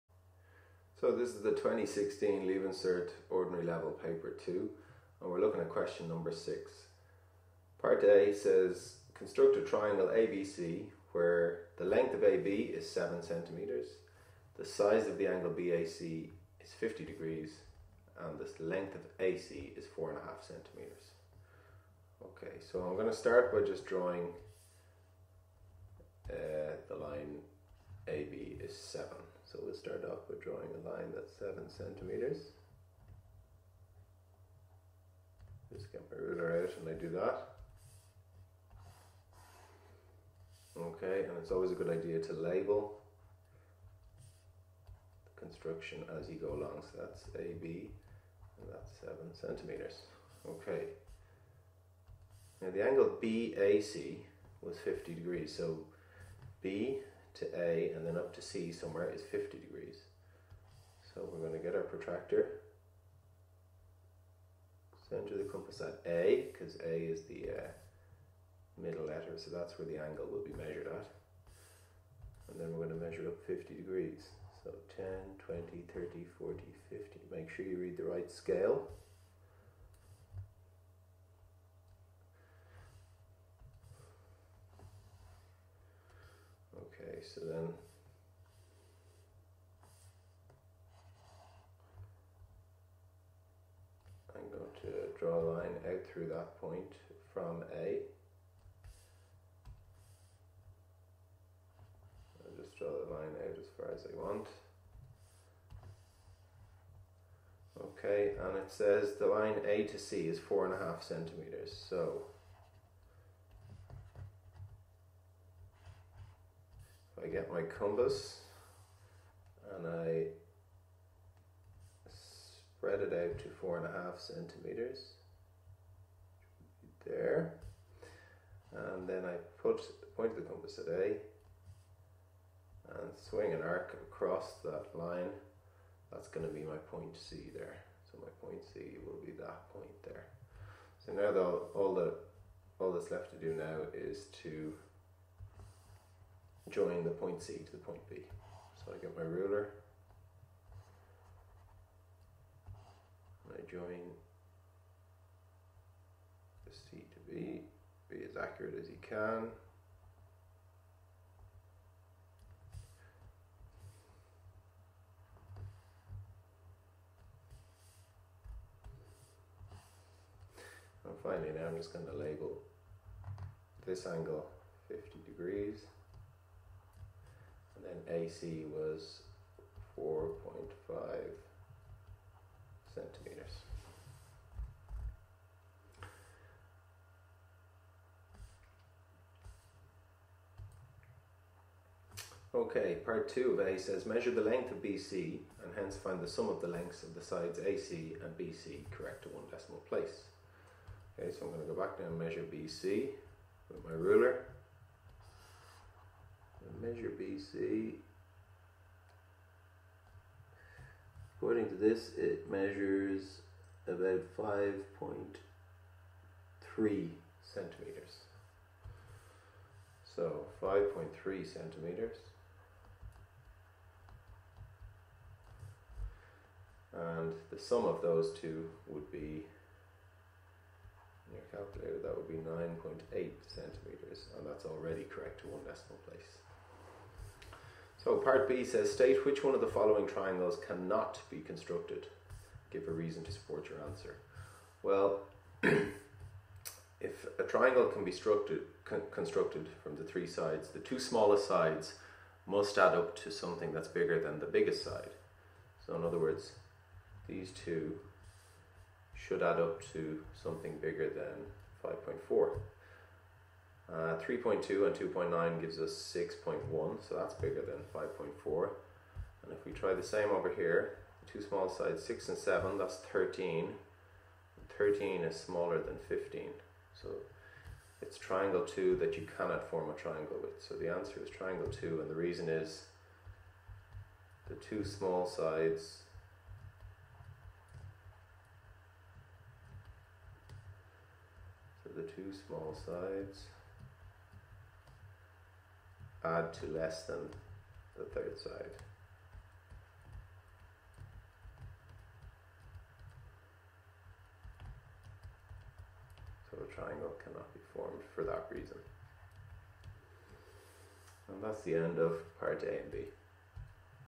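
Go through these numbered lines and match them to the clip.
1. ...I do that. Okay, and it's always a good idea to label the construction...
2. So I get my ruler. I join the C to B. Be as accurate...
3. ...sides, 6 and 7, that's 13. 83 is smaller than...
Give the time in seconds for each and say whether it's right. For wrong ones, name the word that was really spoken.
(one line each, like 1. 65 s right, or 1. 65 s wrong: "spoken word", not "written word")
1. 36 s right
2. 148 s right
3. 271 s wrong: "13", not "83".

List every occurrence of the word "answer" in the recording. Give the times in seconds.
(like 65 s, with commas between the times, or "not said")
243 s, 280 s.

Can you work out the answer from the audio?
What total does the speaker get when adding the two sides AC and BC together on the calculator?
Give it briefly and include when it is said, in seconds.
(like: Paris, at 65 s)
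9.8 centimeters, at 232 s.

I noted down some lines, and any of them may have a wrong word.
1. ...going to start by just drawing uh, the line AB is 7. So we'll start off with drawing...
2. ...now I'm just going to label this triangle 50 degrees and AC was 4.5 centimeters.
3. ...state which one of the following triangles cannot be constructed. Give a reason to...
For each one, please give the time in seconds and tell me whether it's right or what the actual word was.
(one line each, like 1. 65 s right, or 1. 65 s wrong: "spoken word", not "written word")
1. 22 s right
2. 171 s wrong: "angle", not "triangle"
3. 238 s right.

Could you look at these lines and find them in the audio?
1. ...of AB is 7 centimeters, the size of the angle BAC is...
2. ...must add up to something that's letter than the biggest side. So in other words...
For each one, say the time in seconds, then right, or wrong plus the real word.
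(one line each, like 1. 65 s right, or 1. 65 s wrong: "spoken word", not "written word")
1. 12 s right
2. 252 s wrong: "bigger", not "letter".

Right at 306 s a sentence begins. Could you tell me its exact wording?
So a triangle cannot be formed for that reason.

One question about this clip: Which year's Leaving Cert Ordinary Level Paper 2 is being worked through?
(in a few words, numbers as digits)
2016.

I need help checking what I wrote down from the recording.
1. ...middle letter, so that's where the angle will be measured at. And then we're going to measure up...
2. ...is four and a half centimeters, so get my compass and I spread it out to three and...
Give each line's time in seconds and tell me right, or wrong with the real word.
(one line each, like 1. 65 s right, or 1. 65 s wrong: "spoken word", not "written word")
1. 68 s right
2. 110 s wrong: "four", not "three".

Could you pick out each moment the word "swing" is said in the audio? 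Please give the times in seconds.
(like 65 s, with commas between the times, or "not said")
133 s.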